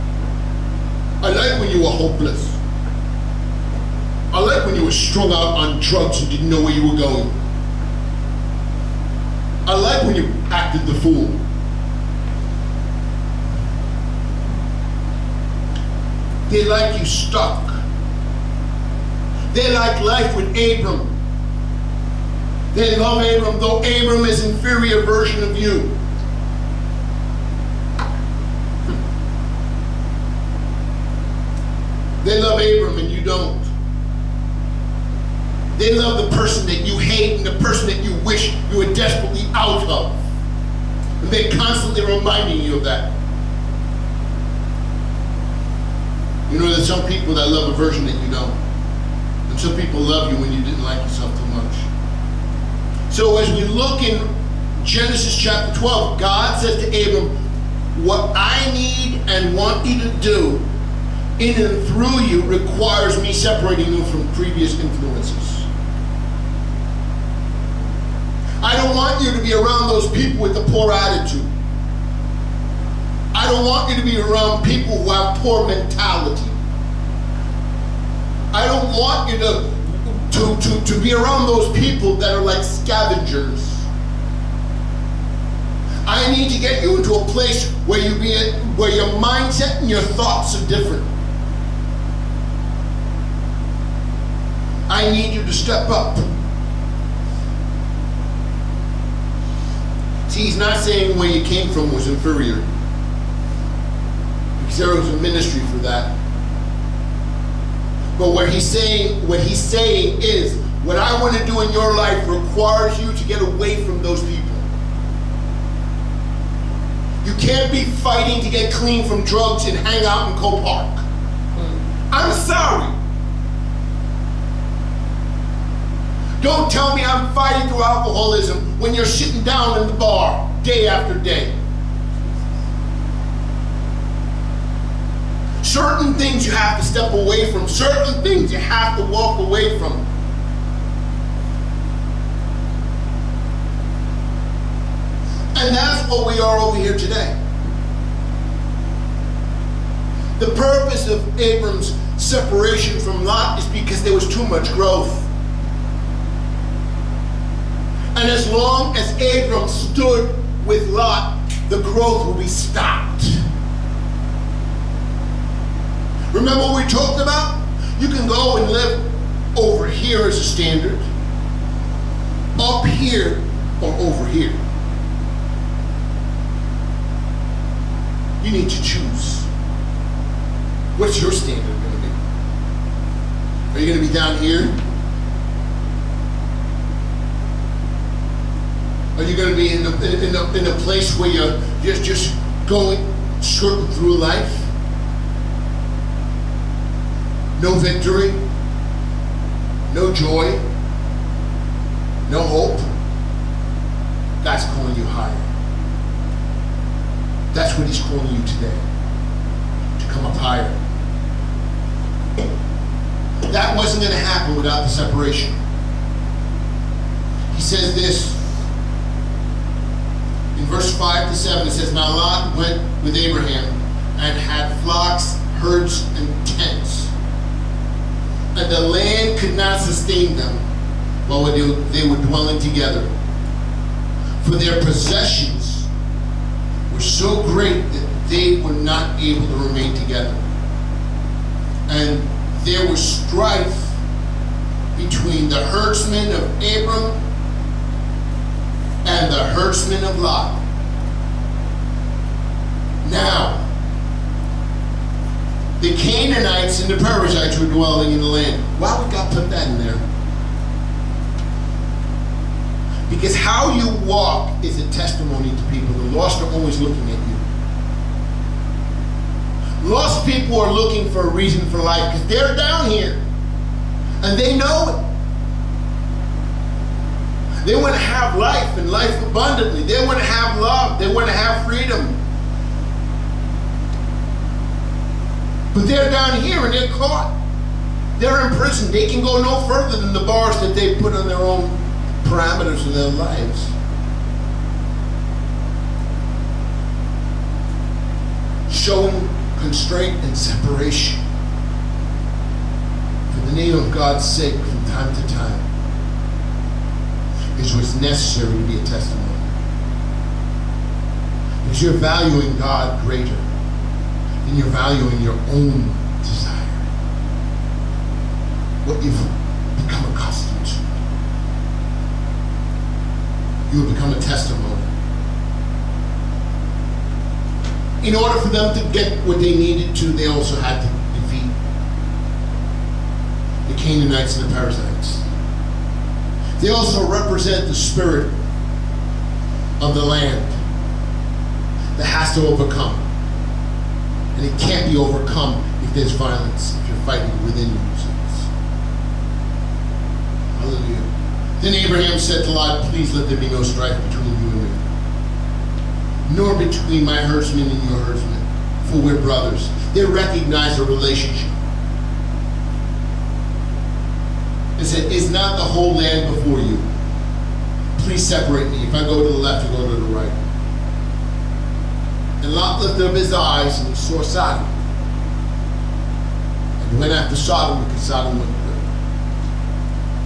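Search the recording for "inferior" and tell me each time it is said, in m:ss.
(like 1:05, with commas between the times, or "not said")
0:24, 1:42.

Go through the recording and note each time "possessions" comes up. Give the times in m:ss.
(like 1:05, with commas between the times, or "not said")
3:54.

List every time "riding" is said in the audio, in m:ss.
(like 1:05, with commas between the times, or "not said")
not said.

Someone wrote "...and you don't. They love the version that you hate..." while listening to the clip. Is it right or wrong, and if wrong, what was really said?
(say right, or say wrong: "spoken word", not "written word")
wrong: "person", not "version".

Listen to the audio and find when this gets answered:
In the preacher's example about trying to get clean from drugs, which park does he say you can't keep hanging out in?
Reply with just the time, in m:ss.
2:00.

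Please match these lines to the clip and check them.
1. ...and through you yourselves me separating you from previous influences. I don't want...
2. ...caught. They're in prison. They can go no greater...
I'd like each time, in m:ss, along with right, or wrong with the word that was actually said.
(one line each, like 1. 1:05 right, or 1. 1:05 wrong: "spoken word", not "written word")
1. 1:01 wrong: "requires", not "yourselves"
2. 4:46 wrong: "further", not "greater".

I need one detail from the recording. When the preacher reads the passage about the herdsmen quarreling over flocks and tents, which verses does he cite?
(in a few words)
5 to 7.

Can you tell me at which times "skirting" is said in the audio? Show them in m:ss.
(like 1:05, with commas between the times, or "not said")
3:13.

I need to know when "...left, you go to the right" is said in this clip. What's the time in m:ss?
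6:09.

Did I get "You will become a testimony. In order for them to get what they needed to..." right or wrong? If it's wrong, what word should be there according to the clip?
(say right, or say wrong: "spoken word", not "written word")
right.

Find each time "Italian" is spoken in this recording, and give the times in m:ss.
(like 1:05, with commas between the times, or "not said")
not said.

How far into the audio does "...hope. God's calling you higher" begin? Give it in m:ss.
3:22.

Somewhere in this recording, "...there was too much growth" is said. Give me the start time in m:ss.
2:34.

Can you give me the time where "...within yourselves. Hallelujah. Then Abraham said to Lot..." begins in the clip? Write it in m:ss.
5:47.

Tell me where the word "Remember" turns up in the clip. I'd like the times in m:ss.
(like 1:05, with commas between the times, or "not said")
2:46.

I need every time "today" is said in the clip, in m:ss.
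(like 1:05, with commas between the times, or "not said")
2:26, 3:28.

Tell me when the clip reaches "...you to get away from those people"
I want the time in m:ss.
1:53.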